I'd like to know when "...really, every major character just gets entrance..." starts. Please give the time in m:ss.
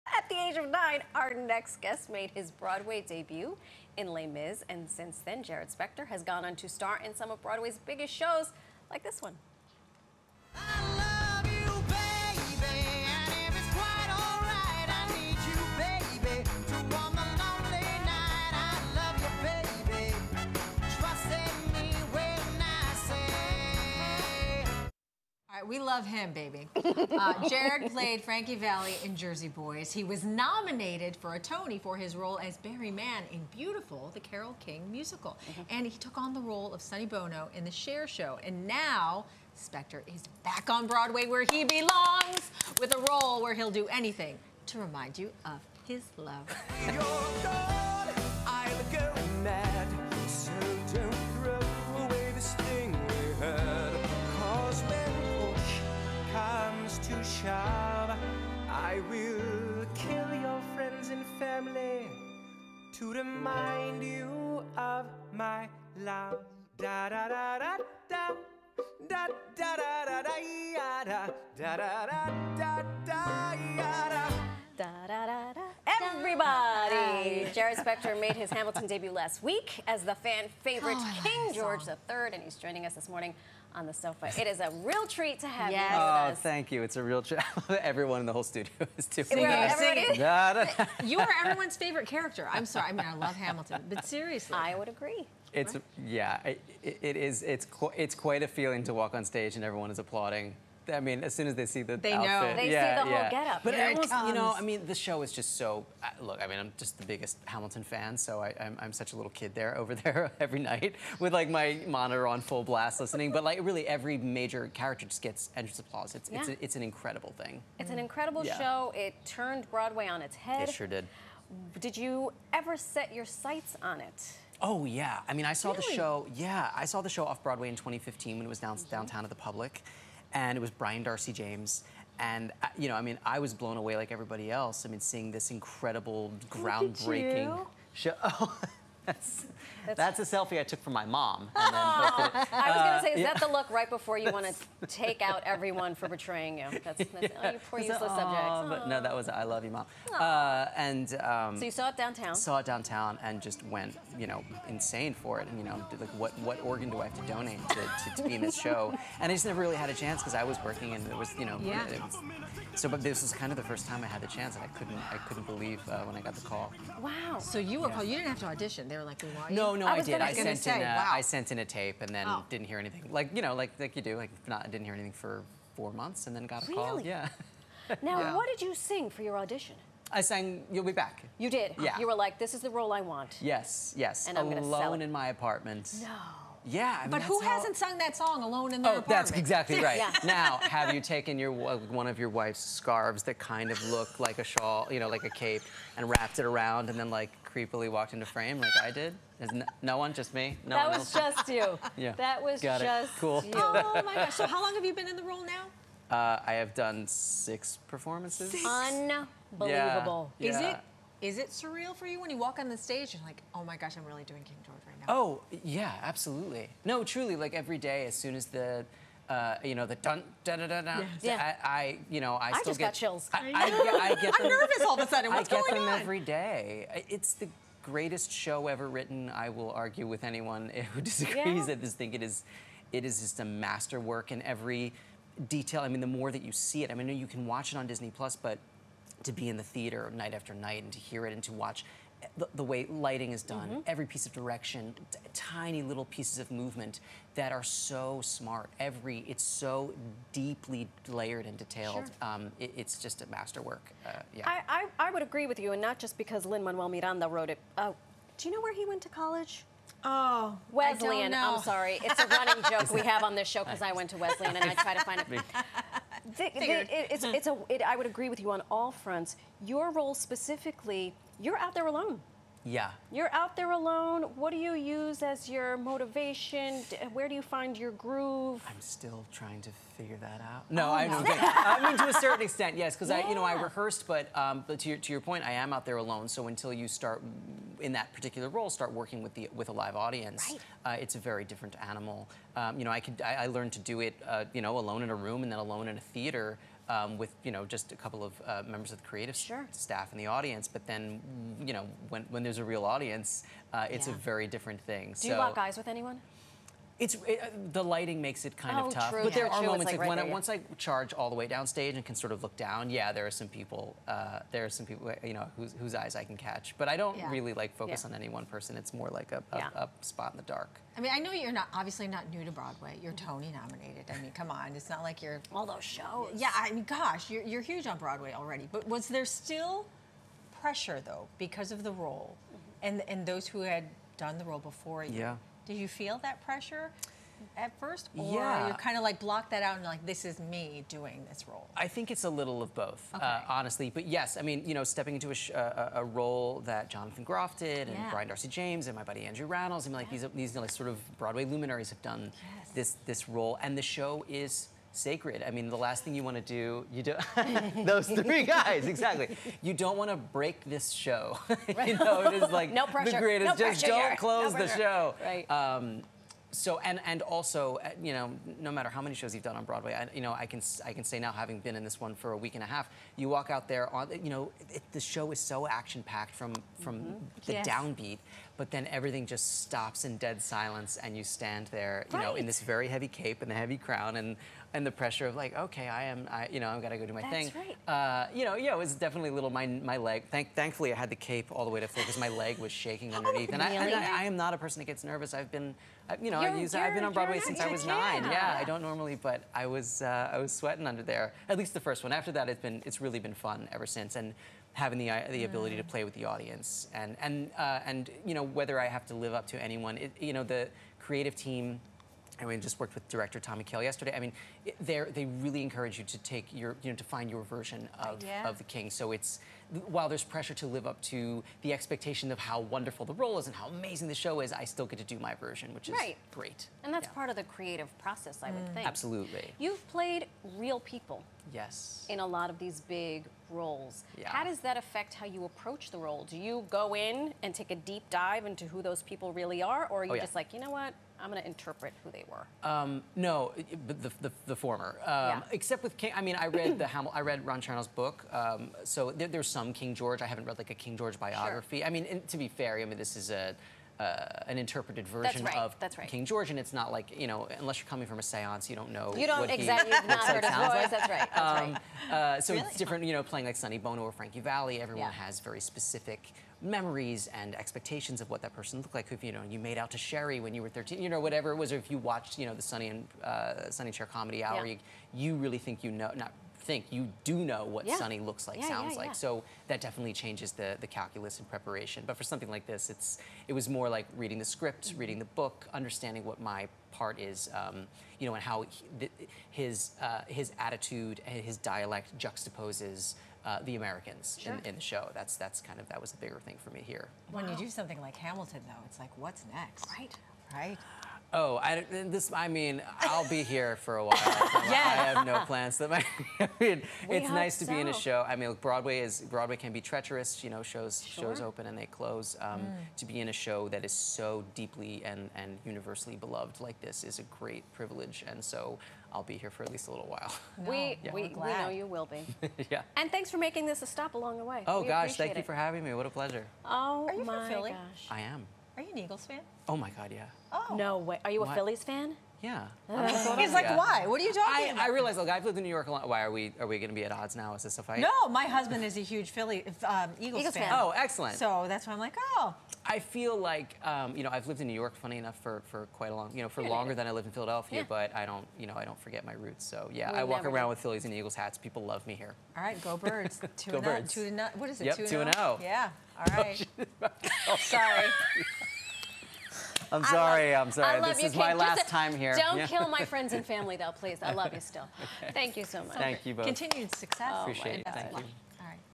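1:53.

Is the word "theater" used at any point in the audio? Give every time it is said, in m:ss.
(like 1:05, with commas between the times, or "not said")
3:59, 4:56.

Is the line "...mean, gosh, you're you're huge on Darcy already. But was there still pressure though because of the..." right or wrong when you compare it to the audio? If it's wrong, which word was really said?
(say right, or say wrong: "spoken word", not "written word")
wrong: "Broadway", not "Darcy".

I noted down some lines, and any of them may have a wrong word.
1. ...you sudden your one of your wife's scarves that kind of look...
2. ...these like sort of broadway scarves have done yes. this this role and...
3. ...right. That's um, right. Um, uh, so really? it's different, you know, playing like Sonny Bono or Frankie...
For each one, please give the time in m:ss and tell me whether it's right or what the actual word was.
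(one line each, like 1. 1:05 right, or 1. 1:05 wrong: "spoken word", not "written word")
1. 3:10 wrong: "taken", not "sudden"
2. 5:50 wrong: "luminaries", not "scarves"
3. 7:41 right.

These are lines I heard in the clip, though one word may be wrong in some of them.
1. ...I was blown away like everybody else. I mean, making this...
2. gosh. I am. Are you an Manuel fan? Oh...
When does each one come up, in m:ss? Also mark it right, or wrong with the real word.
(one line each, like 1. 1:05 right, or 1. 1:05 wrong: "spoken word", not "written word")
1. 2:13 wrong: "seeing", not "making"
2. 8:47 wrong: "Eagles", not "Manuel".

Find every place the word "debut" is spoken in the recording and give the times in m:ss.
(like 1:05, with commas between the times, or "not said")
0:03, 1:18.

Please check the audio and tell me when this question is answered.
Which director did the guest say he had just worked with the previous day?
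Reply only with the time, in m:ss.
6:53.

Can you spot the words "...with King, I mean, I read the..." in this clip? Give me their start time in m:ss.
7:25.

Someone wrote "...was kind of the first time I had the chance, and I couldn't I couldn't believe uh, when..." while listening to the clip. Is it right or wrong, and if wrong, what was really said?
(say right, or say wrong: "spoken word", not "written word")
right.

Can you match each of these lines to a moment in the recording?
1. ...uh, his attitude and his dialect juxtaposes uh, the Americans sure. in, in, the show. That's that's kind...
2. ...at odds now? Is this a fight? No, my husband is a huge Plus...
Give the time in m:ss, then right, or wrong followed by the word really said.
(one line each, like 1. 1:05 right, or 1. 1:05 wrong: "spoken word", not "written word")
1. 8:10 right
2. 8:57 wrong: "Philly", not "Plus".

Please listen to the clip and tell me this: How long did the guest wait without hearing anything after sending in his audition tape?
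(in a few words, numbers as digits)
4 months.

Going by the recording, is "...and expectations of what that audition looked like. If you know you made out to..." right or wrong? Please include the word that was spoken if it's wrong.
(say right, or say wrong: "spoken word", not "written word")
wrong: "person", not "audition".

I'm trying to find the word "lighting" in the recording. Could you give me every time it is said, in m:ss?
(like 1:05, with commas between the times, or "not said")
4:02, 5:07.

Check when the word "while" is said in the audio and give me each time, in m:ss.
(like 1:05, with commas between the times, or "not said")
6:59, 8:24, 8:40.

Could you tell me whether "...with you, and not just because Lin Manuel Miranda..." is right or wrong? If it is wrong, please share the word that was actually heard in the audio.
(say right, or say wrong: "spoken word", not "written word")
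right.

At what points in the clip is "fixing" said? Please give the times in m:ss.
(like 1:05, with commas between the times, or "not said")
not said.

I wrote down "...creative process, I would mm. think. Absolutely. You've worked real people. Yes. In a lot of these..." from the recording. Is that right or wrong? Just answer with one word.
wrong.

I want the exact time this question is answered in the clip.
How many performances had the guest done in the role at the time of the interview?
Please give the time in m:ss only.
3:27.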